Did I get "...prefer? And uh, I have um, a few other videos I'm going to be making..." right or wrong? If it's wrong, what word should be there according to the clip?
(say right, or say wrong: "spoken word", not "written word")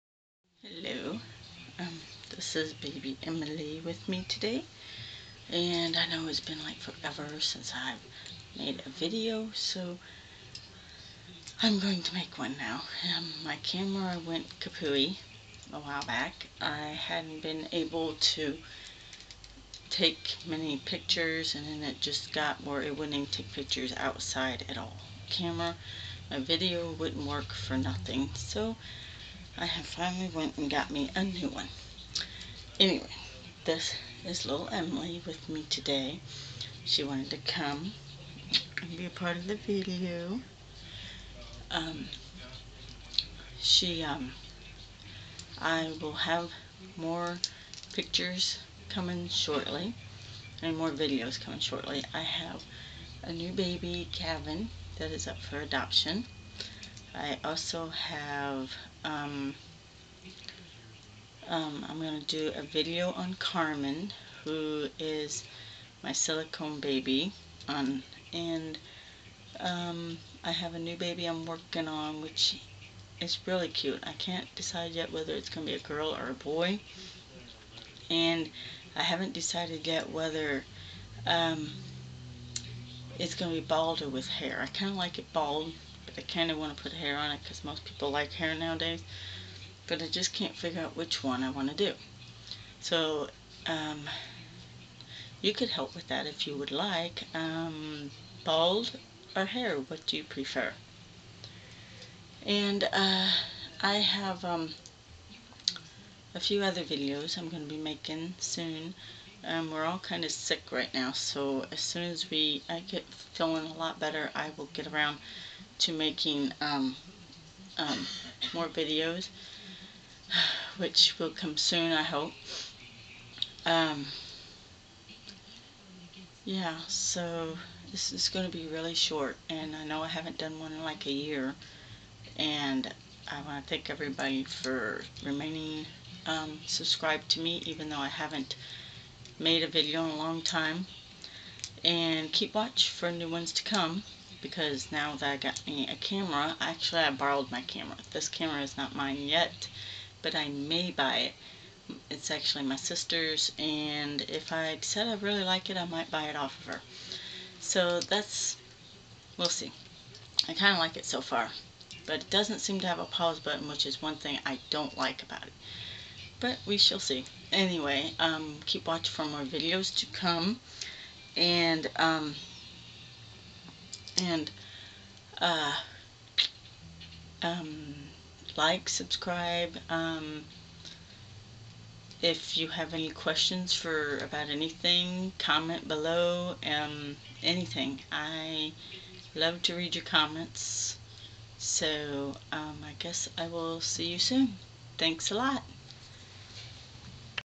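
right.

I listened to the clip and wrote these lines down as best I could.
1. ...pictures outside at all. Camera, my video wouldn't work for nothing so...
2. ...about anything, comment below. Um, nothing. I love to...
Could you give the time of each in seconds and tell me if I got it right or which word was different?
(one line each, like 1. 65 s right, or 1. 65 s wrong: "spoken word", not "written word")
1. 23 s right
2. 184 s wrong: "anything", not "nothing".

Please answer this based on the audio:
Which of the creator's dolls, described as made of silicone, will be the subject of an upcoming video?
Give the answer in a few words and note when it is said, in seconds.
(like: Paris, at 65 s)
Carmen, at 63 s.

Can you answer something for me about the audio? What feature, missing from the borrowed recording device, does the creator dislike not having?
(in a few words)
A pause button.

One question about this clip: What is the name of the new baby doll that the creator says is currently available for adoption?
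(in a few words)
Kevin.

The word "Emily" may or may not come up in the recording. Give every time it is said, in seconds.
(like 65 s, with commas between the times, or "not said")
3 s, 34 s.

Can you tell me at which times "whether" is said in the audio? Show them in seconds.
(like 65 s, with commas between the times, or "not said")
75 s, 80 s.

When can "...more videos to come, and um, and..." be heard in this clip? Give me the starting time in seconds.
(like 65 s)
169 s.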